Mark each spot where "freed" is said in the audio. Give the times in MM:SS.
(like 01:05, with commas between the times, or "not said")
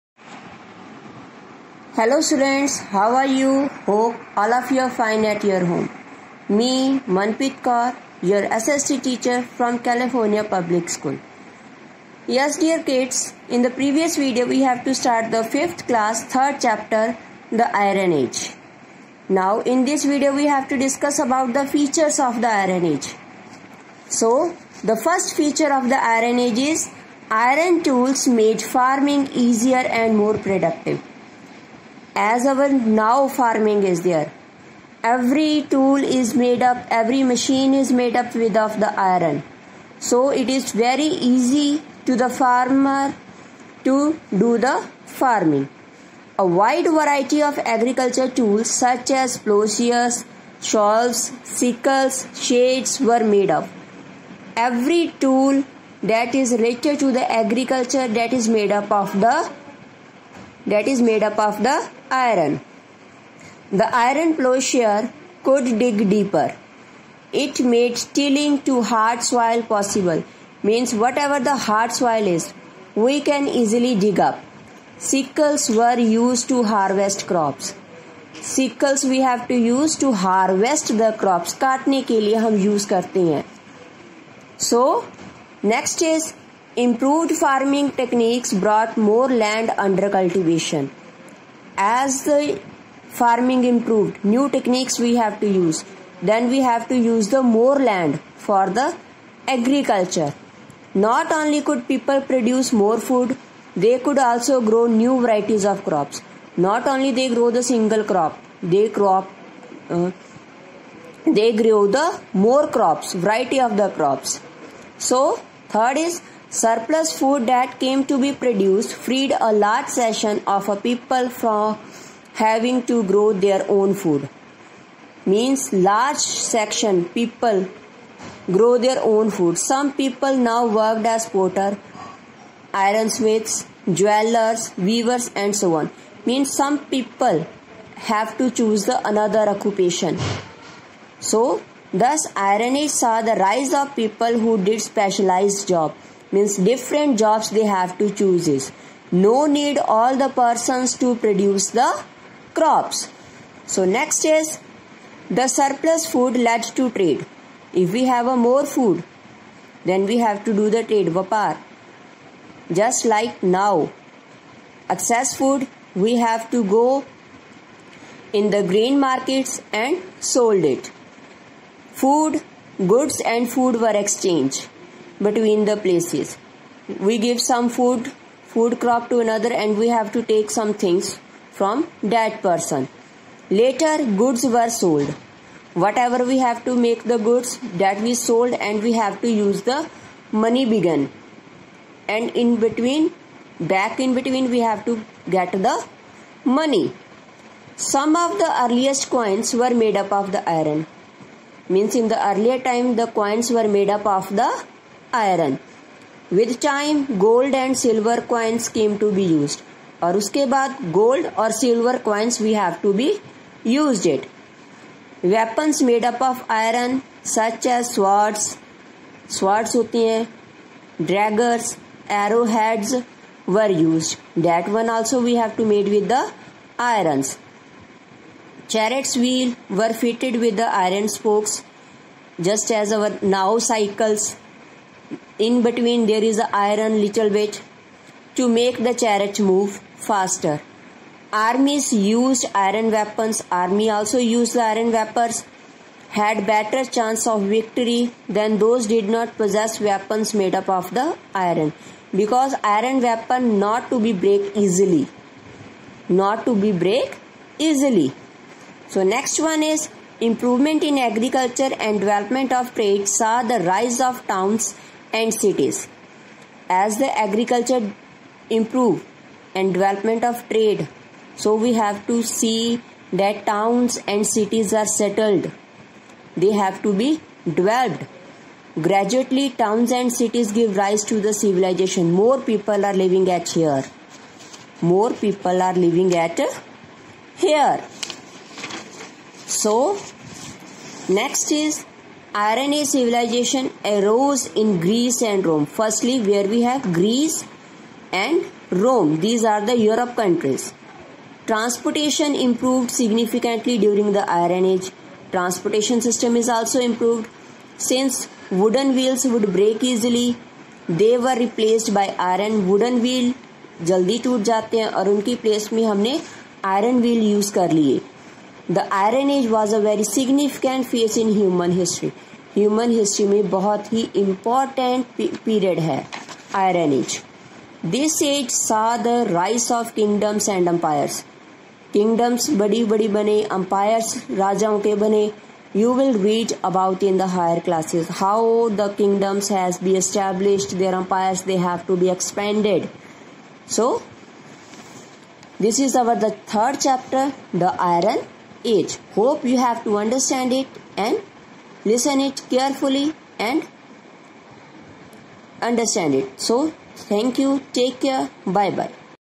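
01:59.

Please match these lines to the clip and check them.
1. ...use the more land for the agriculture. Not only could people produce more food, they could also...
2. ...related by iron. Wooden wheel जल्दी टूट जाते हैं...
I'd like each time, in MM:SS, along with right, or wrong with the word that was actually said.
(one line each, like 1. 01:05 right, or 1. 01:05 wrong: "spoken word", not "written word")
1. 01:36 right
2. 05:11 wrong: "replaced", not "related".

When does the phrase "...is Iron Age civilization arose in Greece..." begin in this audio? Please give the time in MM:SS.
04:51.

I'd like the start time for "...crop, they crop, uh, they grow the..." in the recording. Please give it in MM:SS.
01:48.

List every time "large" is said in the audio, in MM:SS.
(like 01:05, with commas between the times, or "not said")
01:59, 02:05.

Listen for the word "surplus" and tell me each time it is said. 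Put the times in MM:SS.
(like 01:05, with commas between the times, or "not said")
01:56, 02:35.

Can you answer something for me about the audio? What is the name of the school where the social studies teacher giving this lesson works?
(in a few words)
California Public School.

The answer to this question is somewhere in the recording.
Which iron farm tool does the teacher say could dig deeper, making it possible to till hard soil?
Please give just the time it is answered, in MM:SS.
01:03.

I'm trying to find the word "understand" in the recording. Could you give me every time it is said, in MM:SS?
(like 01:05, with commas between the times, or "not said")
05:49, 05:55.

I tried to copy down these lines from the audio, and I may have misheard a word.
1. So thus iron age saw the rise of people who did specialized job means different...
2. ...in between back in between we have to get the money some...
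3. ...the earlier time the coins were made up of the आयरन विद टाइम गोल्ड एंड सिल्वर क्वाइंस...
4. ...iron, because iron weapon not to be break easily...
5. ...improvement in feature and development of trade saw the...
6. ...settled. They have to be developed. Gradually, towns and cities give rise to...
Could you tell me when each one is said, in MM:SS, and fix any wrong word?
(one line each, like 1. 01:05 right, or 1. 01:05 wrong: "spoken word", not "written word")
1. 02:21 right
2. 03:12 right
3. 03:22 right
4. 04:11 right
5. 04:20 wrong: "agriculture", not "feature"
6. 04:34 right.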